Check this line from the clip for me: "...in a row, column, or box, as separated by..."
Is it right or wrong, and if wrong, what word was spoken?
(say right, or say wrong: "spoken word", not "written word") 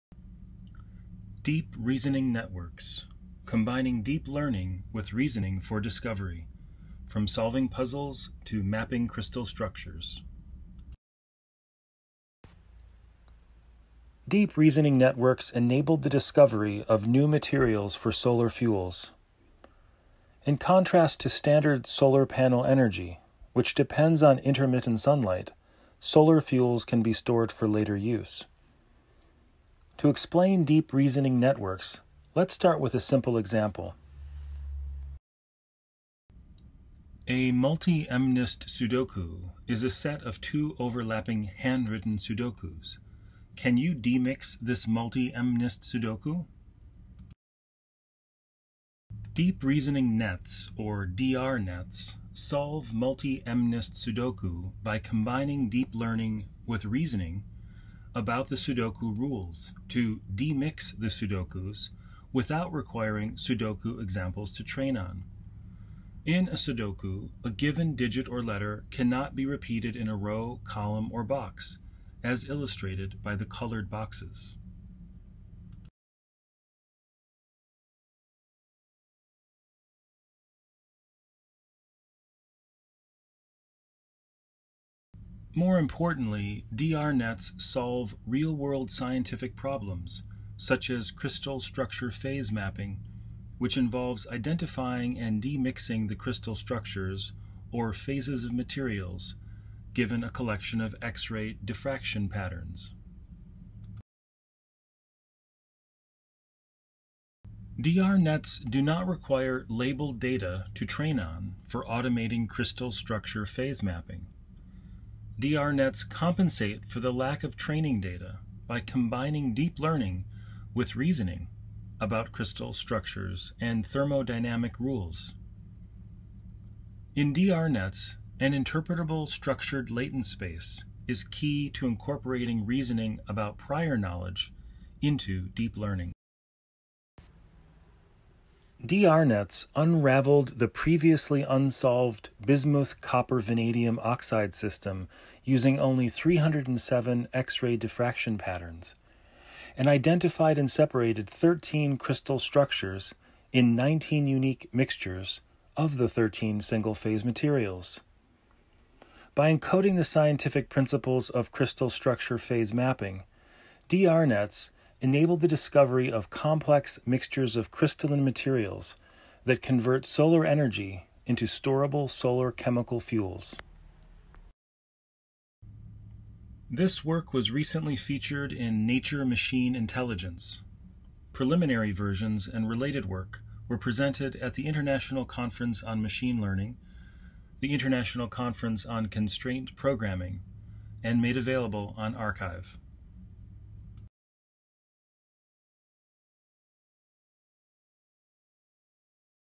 wrong: "illustrated", not "separated".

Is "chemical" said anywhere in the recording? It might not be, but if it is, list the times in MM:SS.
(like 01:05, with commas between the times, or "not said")
02:52.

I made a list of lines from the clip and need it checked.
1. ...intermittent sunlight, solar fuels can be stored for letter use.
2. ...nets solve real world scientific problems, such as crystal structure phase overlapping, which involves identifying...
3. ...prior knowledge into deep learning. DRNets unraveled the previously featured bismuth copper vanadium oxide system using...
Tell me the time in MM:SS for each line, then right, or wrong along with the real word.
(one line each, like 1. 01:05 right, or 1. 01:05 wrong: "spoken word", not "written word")
1. 00:24 wrong: "later", not "letter"
2. 01:27 wrong: "mapping", not "overlapping"
3. 02:13 wrong: "unsolved", not "featured".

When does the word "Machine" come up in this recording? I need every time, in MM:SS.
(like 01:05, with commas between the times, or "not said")
02:59, 03:06.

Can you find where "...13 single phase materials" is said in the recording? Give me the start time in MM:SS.
02:36.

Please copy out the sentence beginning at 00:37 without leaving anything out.
A multi-MNIST Sudoku is a set of two overlapping handwritten Sudokus.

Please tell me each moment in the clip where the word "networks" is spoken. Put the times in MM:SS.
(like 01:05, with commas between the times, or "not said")
00:02, 00:14, 00:31.